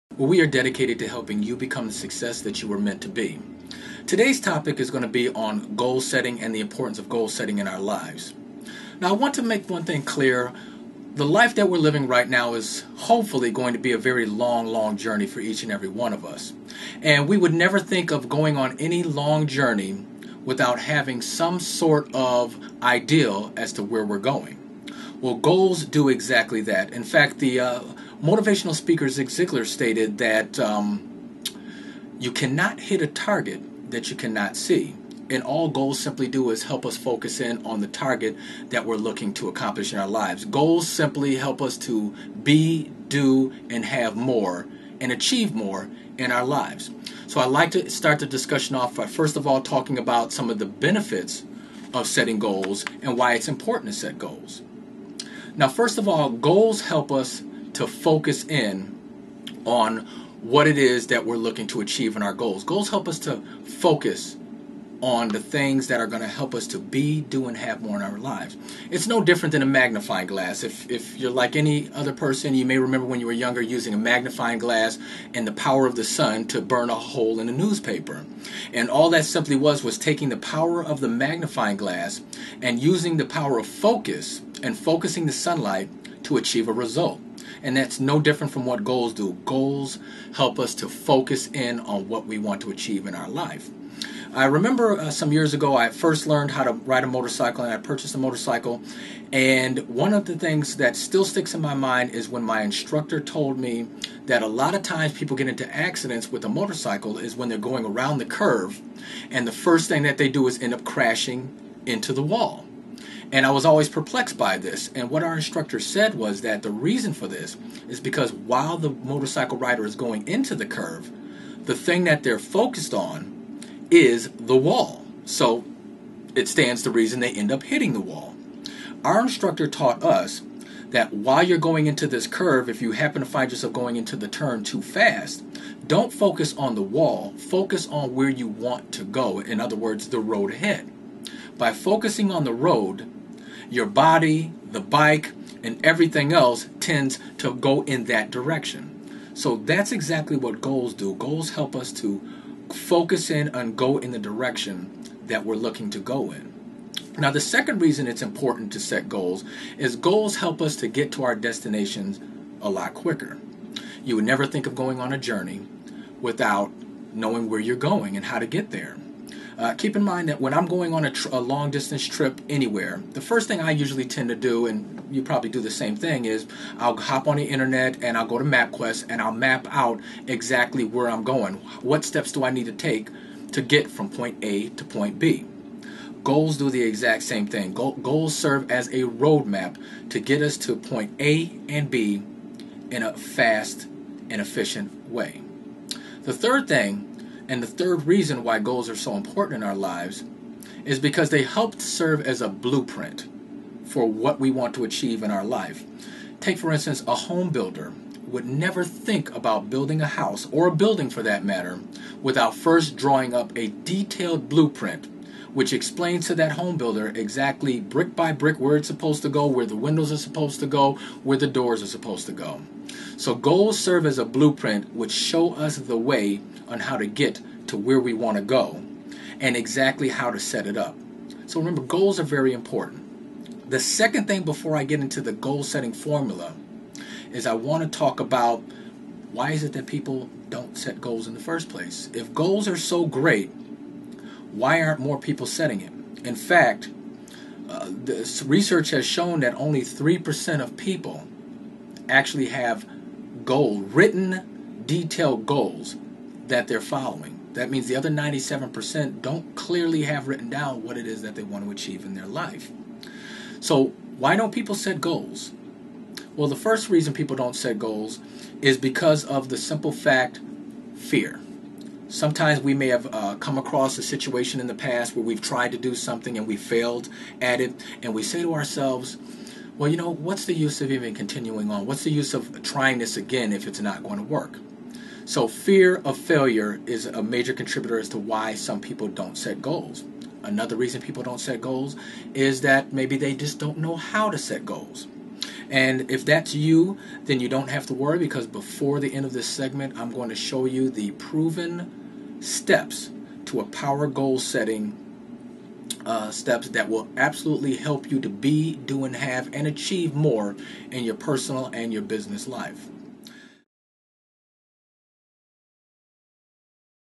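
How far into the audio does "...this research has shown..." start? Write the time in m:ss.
4:07.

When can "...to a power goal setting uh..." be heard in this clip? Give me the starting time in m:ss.
5:03.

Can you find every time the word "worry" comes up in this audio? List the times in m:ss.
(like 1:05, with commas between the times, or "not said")
4:57.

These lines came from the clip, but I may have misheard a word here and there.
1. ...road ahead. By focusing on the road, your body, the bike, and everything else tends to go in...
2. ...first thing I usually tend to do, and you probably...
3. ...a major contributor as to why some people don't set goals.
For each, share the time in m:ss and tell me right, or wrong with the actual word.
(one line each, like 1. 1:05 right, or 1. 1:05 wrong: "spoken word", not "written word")
1. 2:20 right
2. 2:53 right
3. 4:47 right.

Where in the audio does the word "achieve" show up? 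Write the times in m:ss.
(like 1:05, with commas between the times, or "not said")
0:45, 1:01, 1:26, 1:32, 3:24, 4:21, 5:09.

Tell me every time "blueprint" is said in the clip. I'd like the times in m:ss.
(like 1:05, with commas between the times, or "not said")
3:22, 3:34, 3:44.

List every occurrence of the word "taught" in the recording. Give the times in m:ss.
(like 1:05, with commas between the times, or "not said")
2:09.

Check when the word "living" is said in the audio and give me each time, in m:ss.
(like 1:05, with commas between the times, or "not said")
0:11.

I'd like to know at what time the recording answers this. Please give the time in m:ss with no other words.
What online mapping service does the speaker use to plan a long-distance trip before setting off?
2:58.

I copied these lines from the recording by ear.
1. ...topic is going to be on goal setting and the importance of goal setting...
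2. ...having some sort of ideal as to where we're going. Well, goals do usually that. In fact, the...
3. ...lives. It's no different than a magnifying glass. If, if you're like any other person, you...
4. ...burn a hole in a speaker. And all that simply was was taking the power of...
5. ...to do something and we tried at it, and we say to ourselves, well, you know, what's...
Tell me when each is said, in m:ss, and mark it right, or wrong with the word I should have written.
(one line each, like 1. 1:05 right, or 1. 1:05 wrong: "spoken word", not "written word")
1. 0:04 right
2. 0:20 wrong: "exactly", not "usually"
3. 1:08 right
4. 1:16 wrong: "newspaper", not "speaker"
5. 4:35 wrong: "failed", not "tried".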